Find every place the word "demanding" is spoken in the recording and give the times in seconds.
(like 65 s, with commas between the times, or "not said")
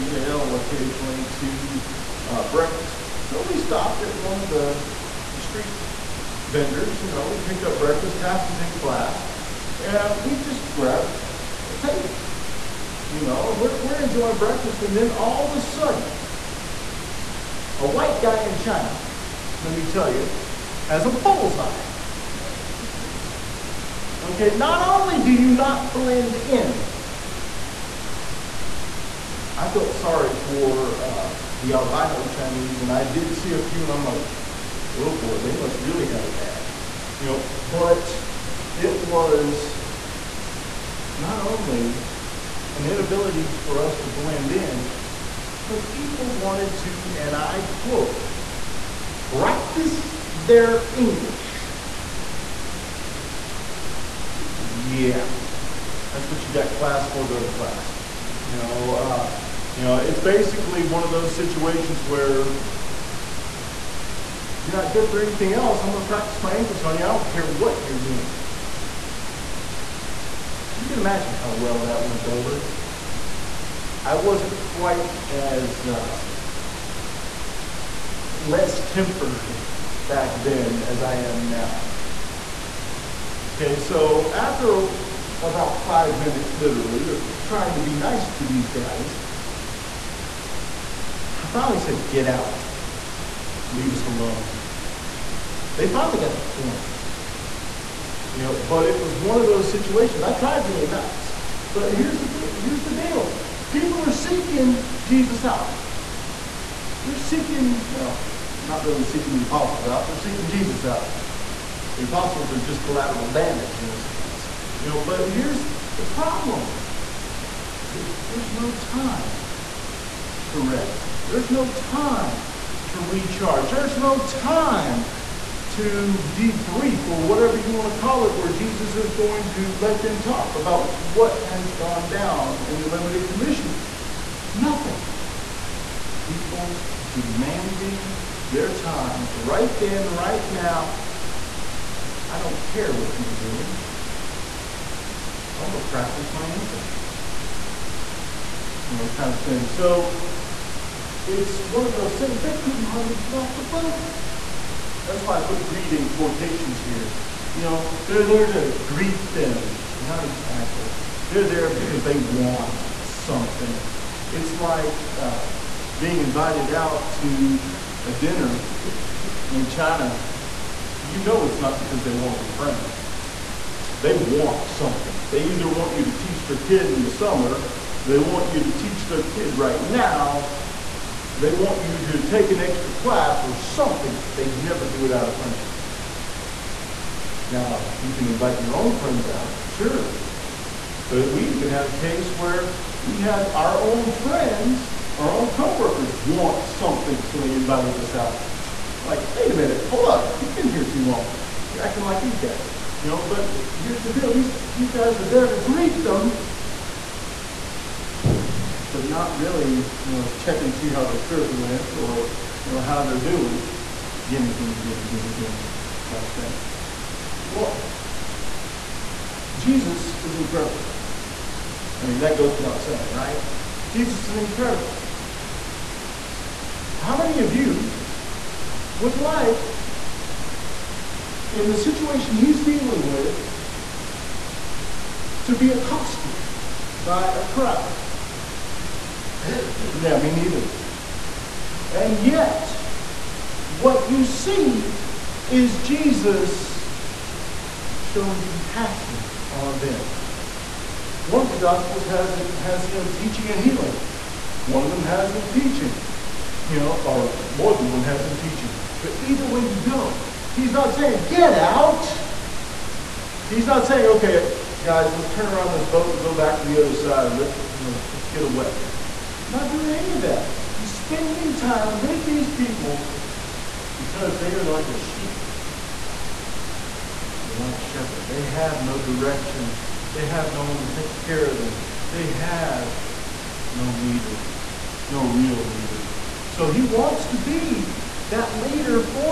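137 s.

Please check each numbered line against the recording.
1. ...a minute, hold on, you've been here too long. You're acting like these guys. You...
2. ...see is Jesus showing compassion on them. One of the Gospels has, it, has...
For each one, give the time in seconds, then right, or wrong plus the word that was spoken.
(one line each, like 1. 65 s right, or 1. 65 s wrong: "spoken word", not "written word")
1. 199 s right
2. 244 s right.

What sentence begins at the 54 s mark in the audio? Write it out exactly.
Yeah, that's what you got class for, go to class.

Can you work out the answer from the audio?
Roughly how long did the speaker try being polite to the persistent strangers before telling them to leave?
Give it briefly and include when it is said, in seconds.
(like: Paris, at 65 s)
5 minutes, at 85 s.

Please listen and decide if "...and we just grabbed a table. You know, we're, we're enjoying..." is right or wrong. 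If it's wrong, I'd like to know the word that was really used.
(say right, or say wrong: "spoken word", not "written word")
right.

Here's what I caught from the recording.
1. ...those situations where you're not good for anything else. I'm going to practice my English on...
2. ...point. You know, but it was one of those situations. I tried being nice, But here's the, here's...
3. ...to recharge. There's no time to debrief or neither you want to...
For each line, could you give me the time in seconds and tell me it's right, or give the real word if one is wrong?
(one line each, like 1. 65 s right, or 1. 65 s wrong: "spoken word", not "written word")
1. 61 s right
2. 96 s right
3. 122 s wrong: "whatever", not "neither".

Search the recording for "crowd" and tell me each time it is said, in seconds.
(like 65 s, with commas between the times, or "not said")
237 s.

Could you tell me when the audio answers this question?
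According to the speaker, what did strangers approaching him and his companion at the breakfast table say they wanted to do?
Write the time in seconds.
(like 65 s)
49 s.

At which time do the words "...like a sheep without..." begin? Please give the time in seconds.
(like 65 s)
274 s.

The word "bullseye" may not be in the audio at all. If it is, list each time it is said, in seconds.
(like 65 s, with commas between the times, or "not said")
21 s.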